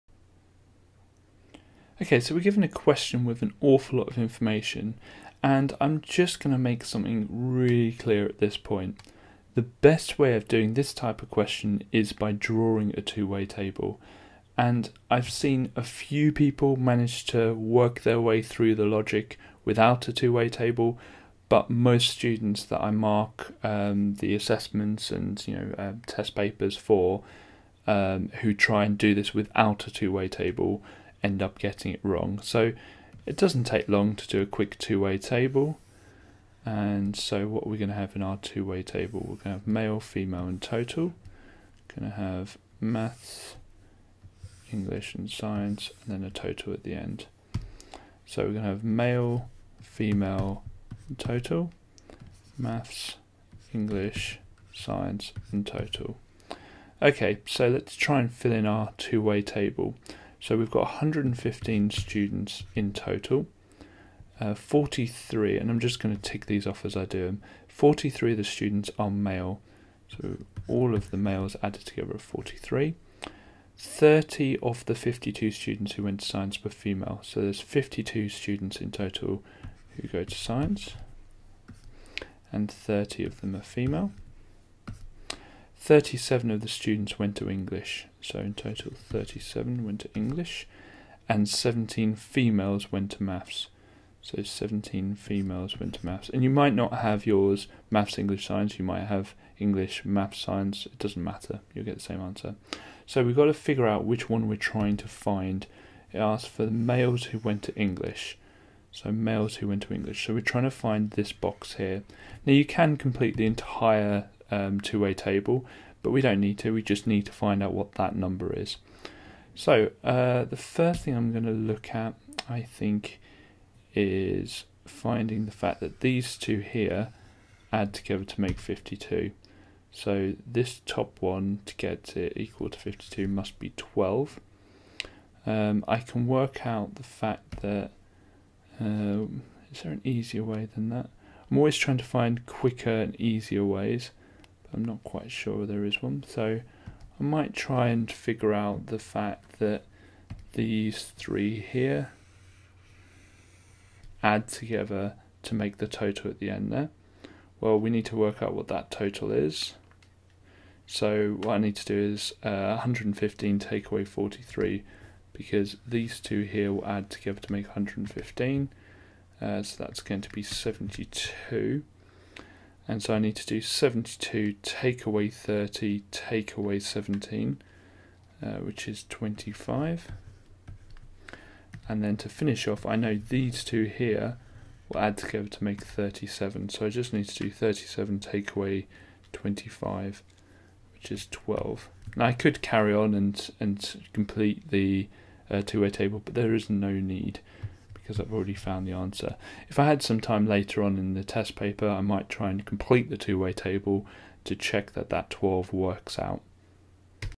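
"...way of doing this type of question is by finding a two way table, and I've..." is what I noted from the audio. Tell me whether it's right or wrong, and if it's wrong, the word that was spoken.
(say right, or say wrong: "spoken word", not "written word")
wrong: "drawing", not "finding".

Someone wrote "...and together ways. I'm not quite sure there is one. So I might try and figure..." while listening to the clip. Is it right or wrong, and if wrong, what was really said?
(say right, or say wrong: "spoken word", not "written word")
wrong: "easier", not "together".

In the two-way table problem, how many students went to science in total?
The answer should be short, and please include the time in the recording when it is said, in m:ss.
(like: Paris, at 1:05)
52, at 1:17.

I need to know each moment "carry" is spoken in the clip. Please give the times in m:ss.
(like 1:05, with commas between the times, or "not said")
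3:12.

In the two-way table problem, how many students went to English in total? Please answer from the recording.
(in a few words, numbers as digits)
37.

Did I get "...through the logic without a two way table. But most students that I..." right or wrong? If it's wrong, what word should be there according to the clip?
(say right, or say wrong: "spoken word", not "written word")
right.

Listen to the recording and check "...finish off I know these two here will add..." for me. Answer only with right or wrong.
right.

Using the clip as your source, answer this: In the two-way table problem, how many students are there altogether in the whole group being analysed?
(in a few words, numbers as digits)
115.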